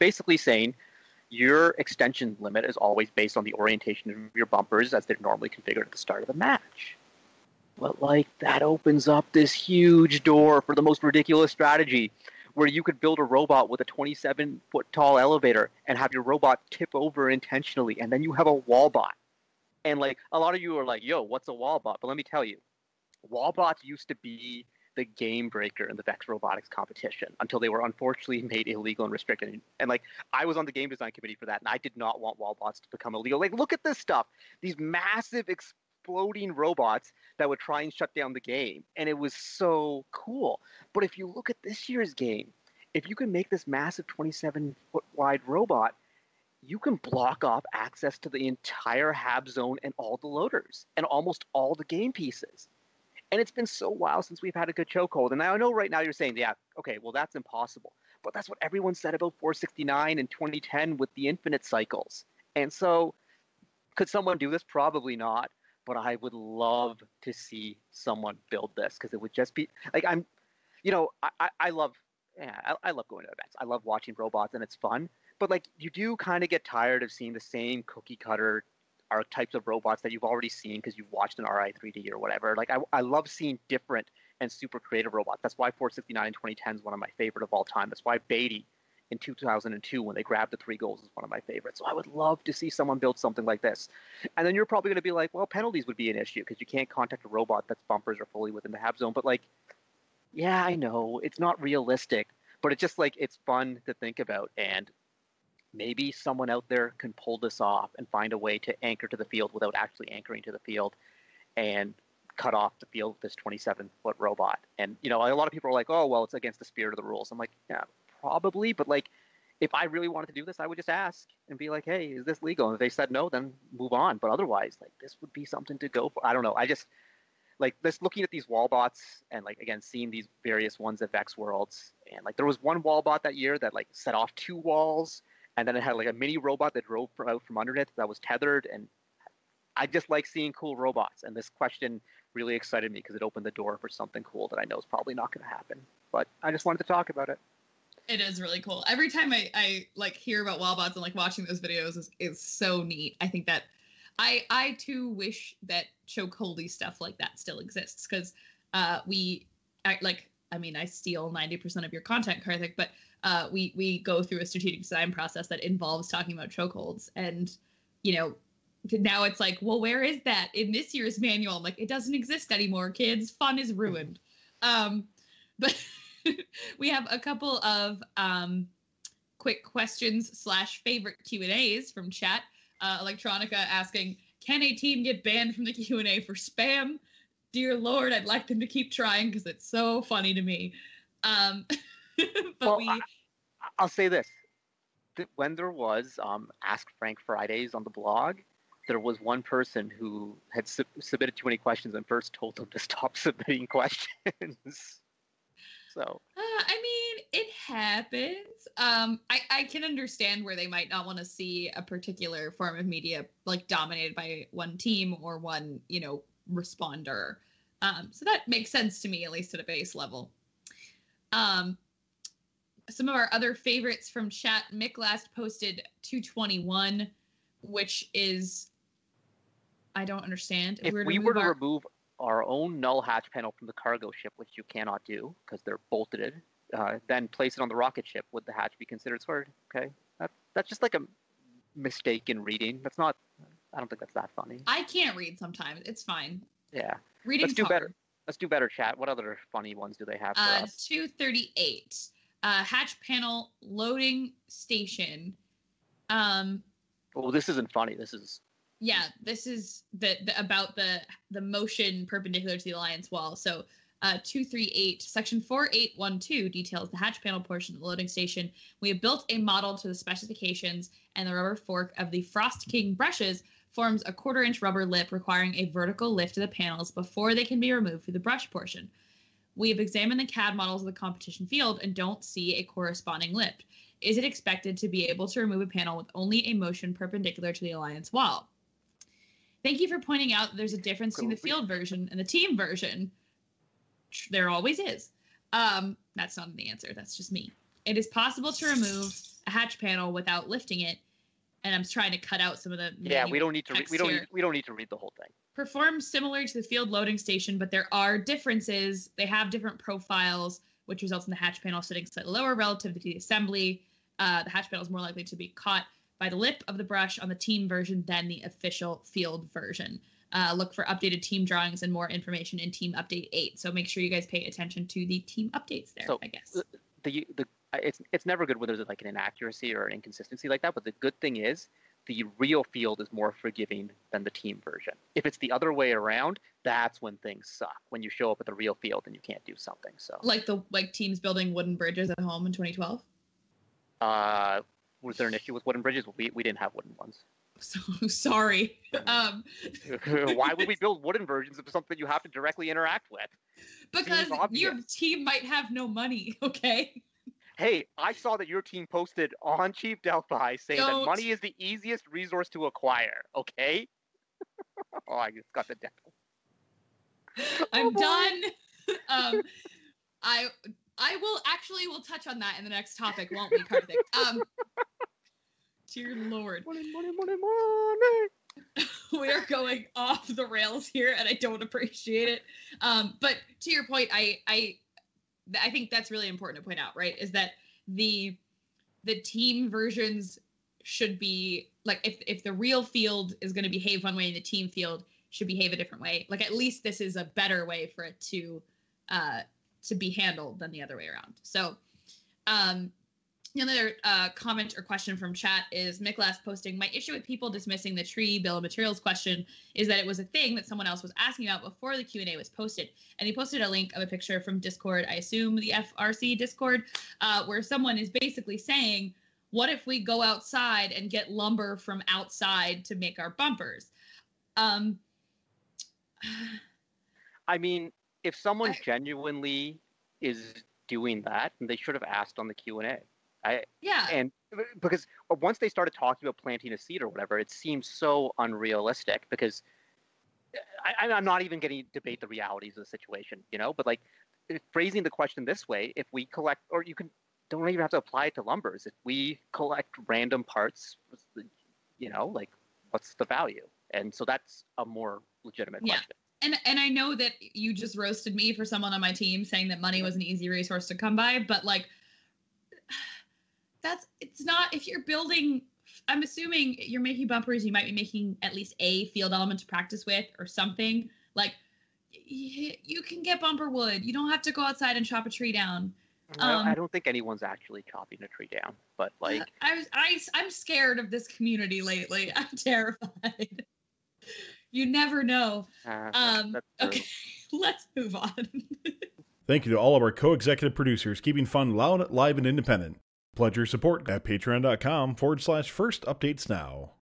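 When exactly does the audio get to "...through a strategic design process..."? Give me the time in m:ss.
2:44.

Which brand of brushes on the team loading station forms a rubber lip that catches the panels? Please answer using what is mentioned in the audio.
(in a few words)
Frost King.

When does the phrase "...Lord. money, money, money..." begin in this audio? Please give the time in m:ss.
6:16.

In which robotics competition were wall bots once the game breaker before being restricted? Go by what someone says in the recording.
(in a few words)
Vex Robotics competition.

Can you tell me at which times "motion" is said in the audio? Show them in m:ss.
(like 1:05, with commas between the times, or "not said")
4:21, 4:46.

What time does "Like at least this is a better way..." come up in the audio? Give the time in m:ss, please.
6:36.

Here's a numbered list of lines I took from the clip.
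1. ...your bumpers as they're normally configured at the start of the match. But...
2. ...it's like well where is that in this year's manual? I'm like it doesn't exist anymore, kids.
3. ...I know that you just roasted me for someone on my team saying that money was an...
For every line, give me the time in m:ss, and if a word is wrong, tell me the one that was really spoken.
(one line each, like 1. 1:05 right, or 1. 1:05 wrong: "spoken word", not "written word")
1. 0:04 right
2. 2:49 right
3. 7:36 right.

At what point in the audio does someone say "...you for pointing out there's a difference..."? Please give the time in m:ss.
4:49.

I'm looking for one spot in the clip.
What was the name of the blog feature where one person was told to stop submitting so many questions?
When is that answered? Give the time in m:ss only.
3:16.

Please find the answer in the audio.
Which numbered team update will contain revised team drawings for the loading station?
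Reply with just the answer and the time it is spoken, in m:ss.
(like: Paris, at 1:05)
Team Update 8, at 5:22.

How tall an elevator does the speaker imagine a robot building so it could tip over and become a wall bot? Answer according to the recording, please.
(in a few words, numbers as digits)
27 foot.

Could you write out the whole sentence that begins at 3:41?
Um, some of our other favorites from chat.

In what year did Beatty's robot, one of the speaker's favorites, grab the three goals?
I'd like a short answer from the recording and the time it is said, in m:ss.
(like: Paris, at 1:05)
2002, at 1:29.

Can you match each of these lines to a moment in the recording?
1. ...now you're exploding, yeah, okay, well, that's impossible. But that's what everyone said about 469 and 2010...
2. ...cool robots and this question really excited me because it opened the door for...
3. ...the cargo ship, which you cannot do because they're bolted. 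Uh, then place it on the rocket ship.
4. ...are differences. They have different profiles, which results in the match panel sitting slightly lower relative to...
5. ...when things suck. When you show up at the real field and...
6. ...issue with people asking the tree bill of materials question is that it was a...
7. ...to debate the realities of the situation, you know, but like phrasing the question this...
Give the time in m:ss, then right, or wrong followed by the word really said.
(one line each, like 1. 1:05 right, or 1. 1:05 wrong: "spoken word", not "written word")
1. 0:55 wrong: "saying", not "exploding"
2. 2:20 right
3. 3:53 right
4. 5:07 wrong: "hatch", not "match"
5. 5:37 right
6. 6:46 wrong: "dismissing", not "asking"
7. 7:21 right.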